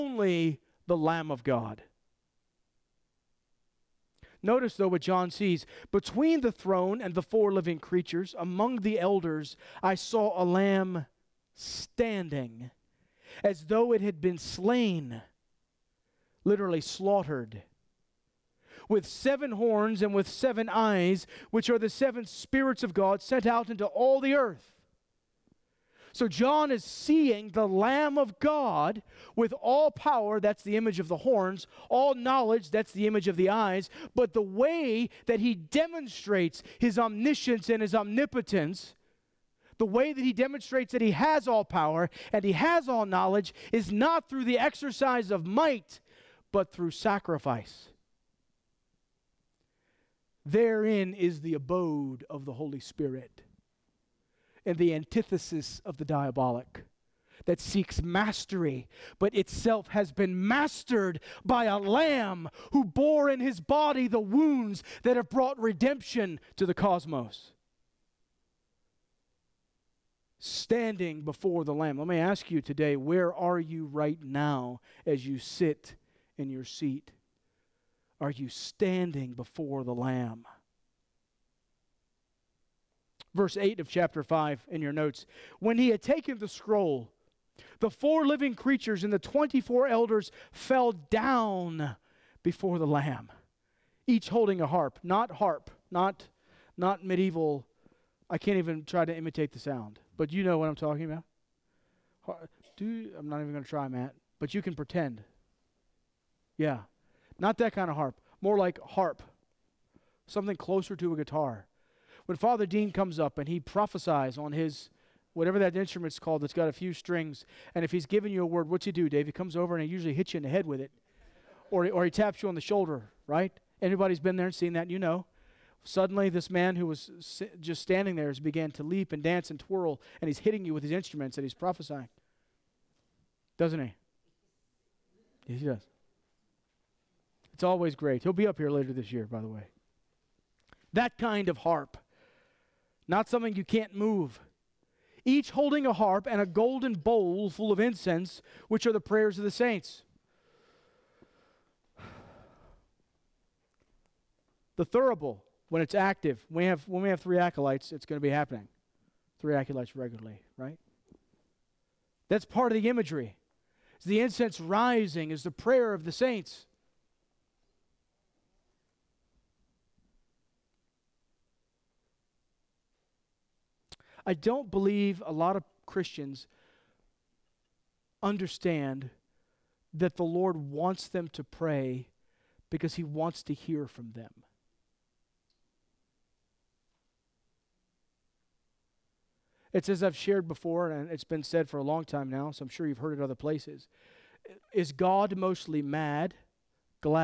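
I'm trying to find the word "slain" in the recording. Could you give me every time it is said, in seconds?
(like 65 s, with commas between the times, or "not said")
14 s.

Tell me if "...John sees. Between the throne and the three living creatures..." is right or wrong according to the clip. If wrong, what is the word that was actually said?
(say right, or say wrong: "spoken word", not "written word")
wrong: "four", not "three".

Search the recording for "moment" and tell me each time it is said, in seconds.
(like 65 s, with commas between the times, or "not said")
not said.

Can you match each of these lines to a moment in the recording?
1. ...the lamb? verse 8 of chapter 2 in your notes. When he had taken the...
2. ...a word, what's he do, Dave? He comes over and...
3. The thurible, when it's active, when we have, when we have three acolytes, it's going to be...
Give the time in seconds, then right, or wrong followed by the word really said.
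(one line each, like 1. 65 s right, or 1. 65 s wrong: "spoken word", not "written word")
1. 79 s wrong: "5", not "2"
2. 118 s right
3. 154 s right.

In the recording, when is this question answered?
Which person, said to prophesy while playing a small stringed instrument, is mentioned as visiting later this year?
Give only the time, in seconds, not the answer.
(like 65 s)
112 s.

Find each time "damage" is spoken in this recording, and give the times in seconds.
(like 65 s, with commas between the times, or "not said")
not said.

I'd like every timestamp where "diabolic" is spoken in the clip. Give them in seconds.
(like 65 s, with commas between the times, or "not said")
56 s.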